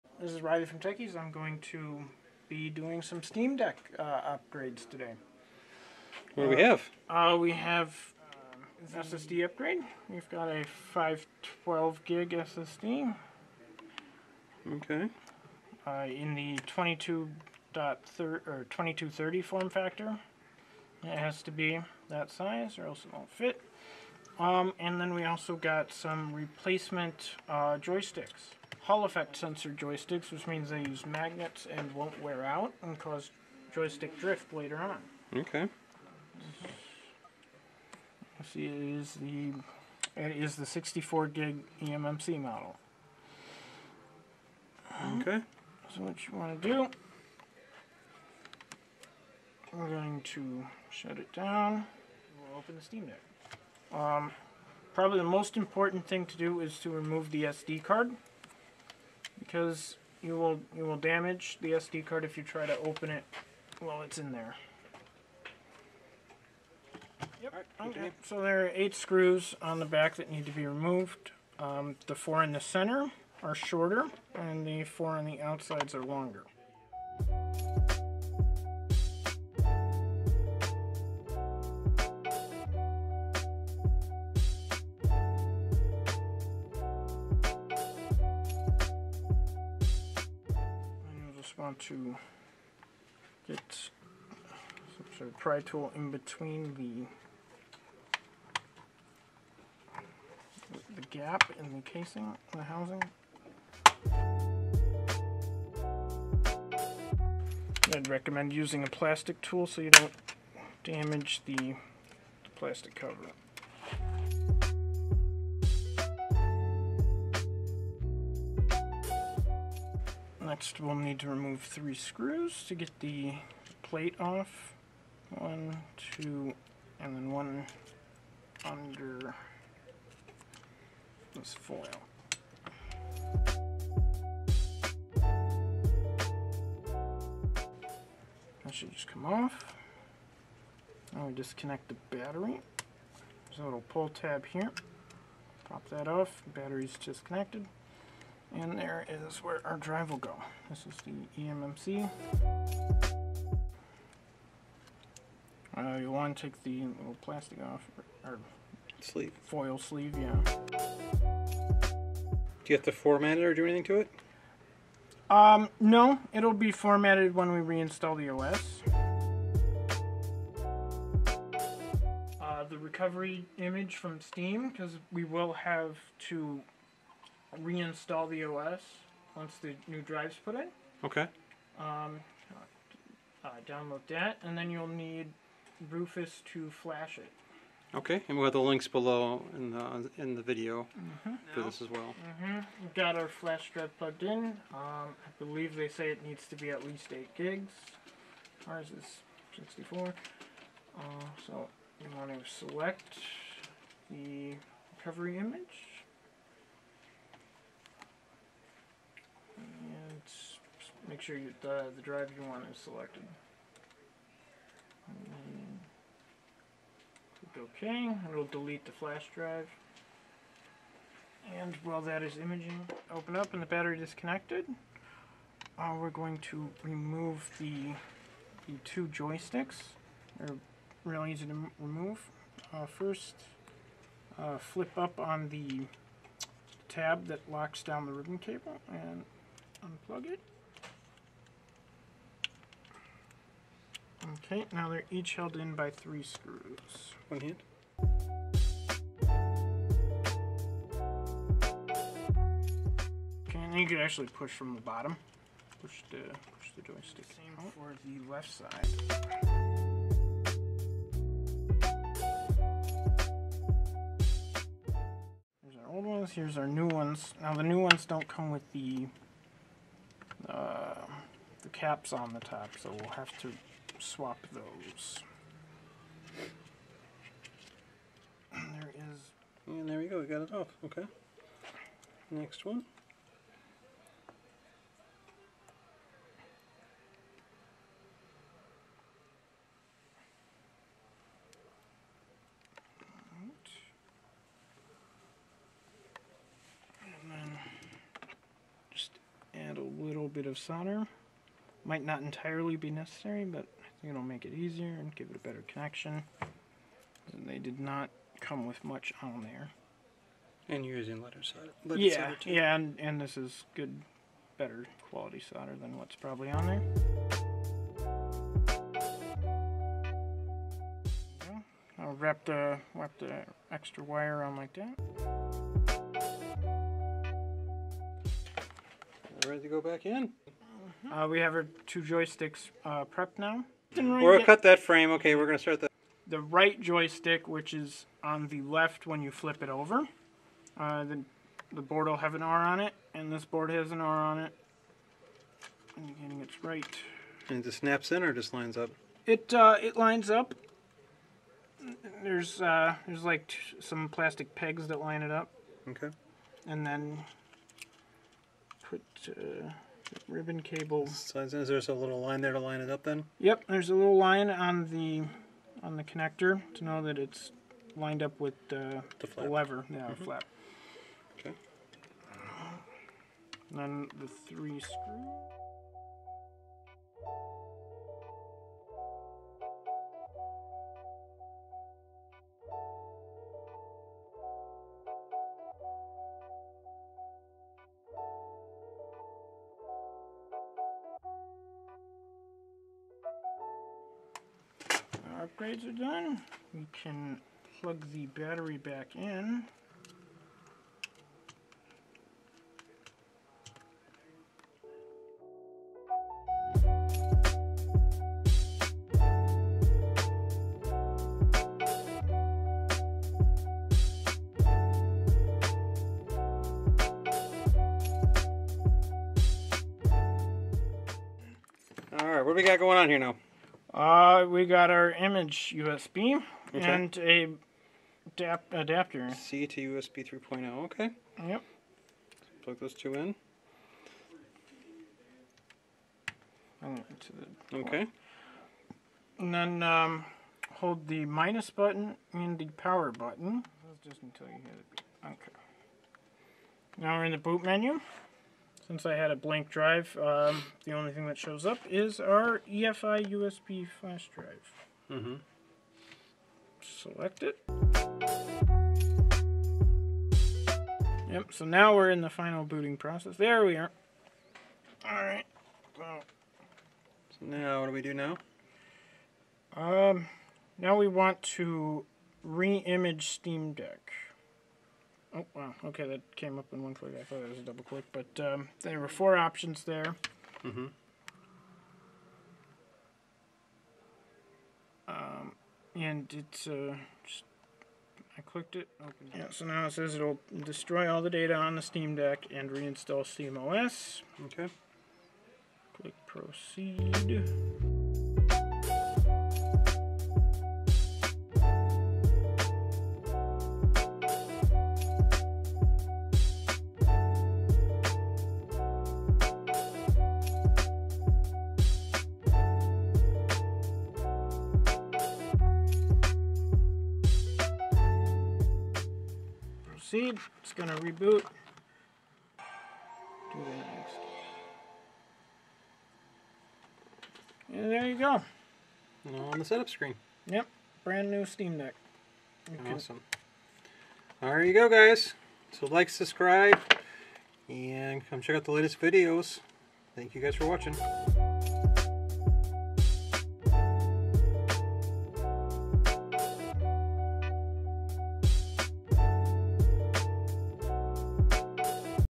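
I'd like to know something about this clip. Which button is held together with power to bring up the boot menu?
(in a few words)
minus button.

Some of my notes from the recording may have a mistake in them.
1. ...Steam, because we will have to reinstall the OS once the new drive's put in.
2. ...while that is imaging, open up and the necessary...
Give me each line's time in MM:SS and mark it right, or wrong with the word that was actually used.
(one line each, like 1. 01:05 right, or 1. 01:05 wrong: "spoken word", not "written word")
1. 02:54 right
2. 03:41 wrong: "battery", not "necessary".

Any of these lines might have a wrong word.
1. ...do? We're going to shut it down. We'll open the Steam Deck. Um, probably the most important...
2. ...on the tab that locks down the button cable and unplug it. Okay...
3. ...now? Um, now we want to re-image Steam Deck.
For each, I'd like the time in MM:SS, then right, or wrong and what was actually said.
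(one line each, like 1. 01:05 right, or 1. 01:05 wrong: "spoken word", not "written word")
1. 00:46 right
2. 03:55 wrong: "ribbon", not "button"
3. 07:48 right.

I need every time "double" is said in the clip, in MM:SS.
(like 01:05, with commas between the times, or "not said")
07:57.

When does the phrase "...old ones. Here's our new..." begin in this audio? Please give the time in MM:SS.
04:25.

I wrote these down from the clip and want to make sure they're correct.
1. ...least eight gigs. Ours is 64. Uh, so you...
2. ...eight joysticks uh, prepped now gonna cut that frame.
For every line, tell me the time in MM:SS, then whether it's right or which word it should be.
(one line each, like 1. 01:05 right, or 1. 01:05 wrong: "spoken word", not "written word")
1. 03:16 right
2. 05:31 wrong: "two", not "eight".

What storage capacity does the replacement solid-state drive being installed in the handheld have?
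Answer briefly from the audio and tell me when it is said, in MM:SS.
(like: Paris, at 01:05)
512 GB, at 00:10.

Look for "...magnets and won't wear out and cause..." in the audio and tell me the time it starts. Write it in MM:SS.
00:31.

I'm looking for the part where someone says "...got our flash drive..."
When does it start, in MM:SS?
03:13.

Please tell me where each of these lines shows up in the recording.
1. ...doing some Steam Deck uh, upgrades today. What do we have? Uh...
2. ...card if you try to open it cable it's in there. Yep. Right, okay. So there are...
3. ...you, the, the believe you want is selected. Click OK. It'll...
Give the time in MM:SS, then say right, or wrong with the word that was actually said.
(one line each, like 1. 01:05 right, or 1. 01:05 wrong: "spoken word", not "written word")
1. 00:02 right
2. 01:02 wrong: "while", not "cable"
3. 03:31 wrong: "drive", not "believe".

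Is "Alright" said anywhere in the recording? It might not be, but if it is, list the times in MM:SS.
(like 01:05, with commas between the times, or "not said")
07:02, 07:45.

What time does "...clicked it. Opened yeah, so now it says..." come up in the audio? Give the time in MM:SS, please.
08:08.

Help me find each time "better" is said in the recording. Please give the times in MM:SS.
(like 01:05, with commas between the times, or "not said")
05:05, 05:14.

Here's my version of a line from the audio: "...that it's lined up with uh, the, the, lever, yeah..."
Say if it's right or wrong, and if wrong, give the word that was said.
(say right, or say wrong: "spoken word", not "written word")
right.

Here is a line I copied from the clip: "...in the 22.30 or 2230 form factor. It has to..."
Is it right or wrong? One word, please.
right.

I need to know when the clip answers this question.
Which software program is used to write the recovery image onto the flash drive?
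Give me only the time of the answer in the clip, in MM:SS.
03:05.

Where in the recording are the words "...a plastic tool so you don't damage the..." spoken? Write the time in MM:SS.
01:48.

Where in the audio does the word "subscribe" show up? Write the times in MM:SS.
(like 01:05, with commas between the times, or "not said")
08:56.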